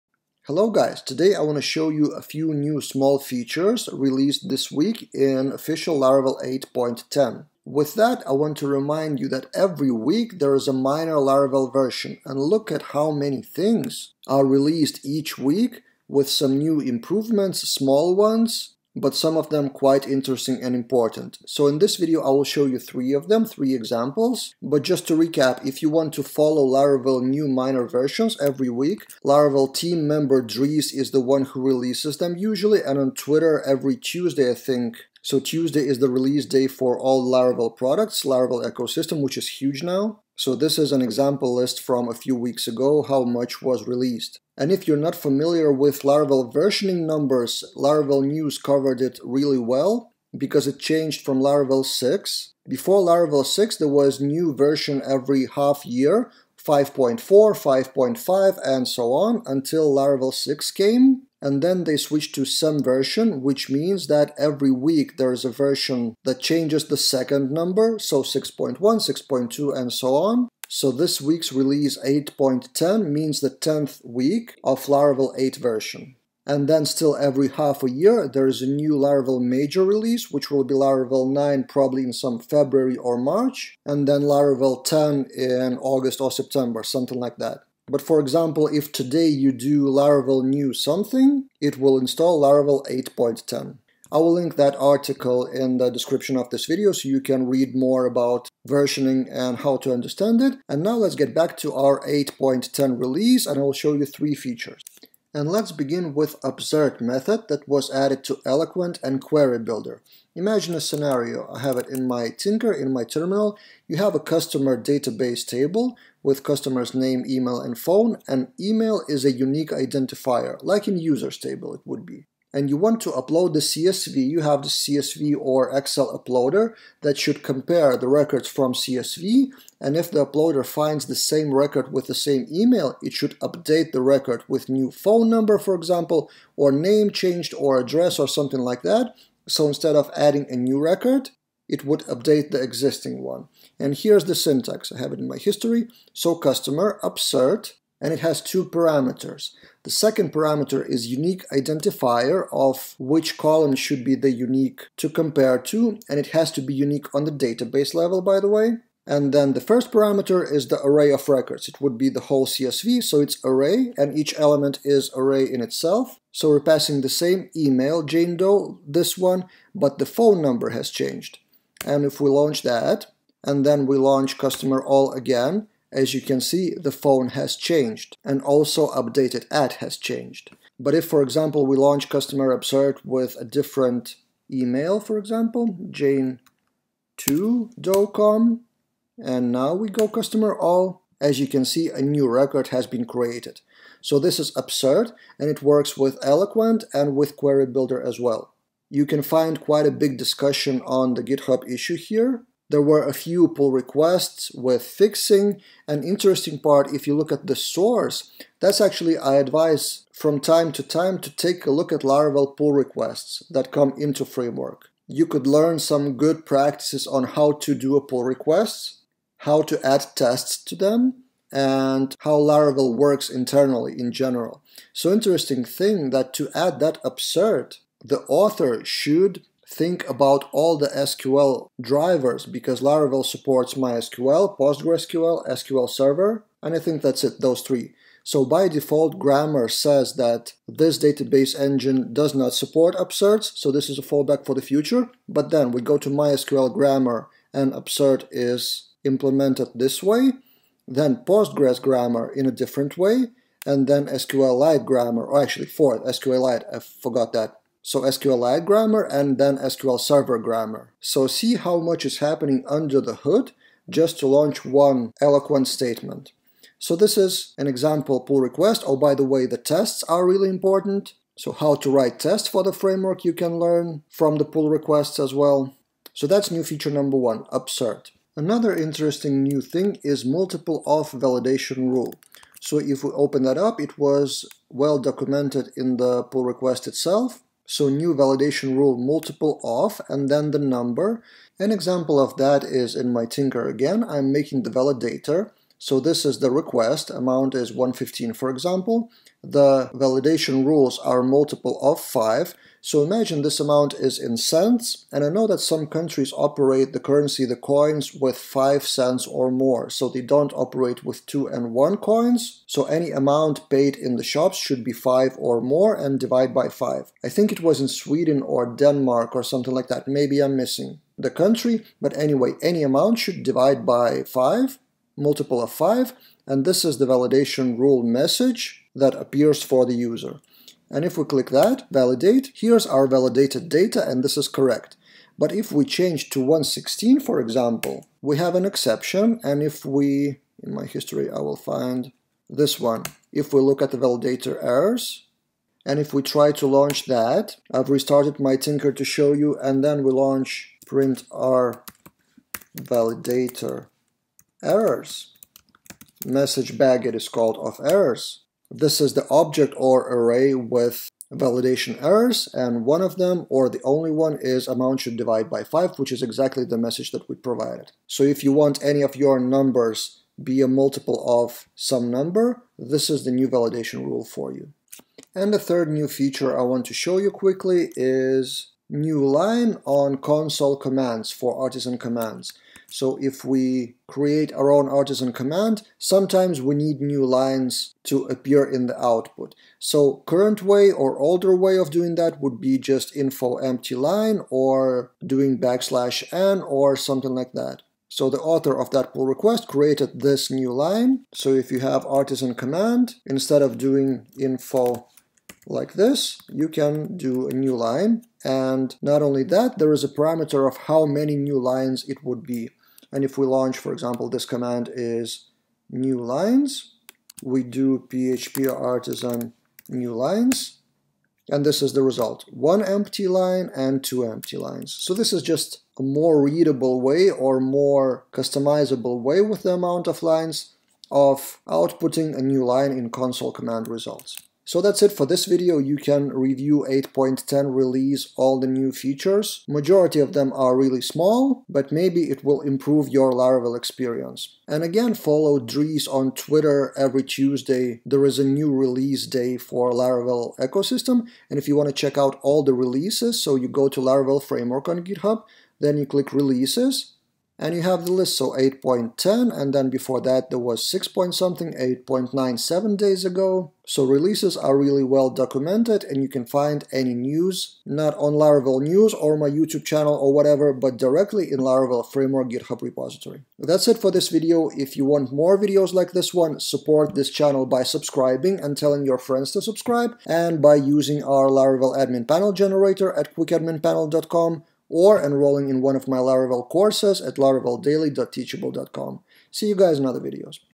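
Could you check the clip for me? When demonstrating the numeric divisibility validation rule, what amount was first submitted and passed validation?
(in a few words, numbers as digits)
115.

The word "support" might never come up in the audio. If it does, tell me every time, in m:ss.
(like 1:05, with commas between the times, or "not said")
3:53, 4:02, 7:56.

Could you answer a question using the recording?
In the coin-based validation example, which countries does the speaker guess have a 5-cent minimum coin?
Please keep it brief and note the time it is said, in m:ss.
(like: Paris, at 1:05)
Sweden or Denmark, at 5:17.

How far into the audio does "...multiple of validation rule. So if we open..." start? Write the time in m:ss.
4:40.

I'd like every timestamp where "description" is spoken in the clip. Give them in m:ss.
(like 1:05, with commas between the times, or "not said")
1:35.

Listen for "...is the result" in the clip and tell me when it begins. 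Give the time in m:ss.
7:01.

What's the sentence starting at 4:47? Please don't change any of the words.
So new validation rule multiple of and then the number.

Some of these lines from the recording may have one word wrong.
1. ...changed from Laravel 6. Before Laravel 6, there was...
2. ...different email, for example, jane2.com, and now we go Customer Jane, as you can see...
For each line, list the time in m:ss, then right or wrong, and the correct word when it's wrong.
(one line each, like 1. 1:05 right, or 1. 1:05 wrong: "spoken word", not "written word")
1. 0:50 right
2. 3:03 wrong: "All", not "Jane".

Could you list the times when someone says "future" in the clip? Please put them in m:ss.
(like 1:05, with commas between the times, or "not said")
4:04.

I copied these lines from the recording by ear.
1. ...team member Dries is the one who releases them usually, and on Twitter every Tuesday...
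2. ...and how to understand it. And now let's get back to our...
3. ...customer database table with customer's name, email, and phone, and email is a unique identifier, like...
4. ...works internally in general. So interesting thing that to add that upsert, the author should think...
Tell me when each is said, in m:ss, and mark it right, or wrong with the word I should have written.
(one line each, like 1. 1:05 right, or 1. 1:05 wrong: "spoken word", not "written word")
1. 0:29 right
2. 1:39 right
3. 1:54 right
4. 3:42 right.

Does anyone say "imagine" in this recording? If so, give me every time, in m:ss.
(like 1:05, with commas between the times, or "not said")
1:50, 5:03.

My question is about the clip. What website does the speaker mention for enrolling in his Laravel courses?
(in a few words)
laraveldaily.teachable.com.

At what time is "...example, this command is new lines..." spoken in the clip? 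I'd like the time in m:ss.
6:53.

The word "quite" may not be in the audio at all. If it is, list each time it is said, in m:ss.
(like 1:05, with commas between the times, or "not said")
0:19, 3:19.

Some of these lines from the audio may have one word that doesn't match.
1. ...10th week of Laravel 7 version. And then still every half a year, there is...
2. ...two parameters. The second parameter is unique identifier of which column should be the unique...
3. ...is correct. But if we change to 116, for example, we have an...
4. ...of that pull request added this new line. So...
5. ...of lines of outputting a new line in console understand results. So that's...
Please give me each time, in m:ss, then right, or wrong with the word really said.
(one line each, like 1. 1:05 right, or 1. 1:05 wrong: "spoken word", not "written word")
1. 1:13 wrong: "8", not "7"
2. 2:28 right
3. 5:34 right
4. 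6:38 wrong: "created", not "added"
5. 7:10 wrong: "command", not "understand".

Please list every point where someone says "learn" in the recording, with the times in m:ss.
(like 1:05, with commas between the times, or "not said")
3:35, 4:33.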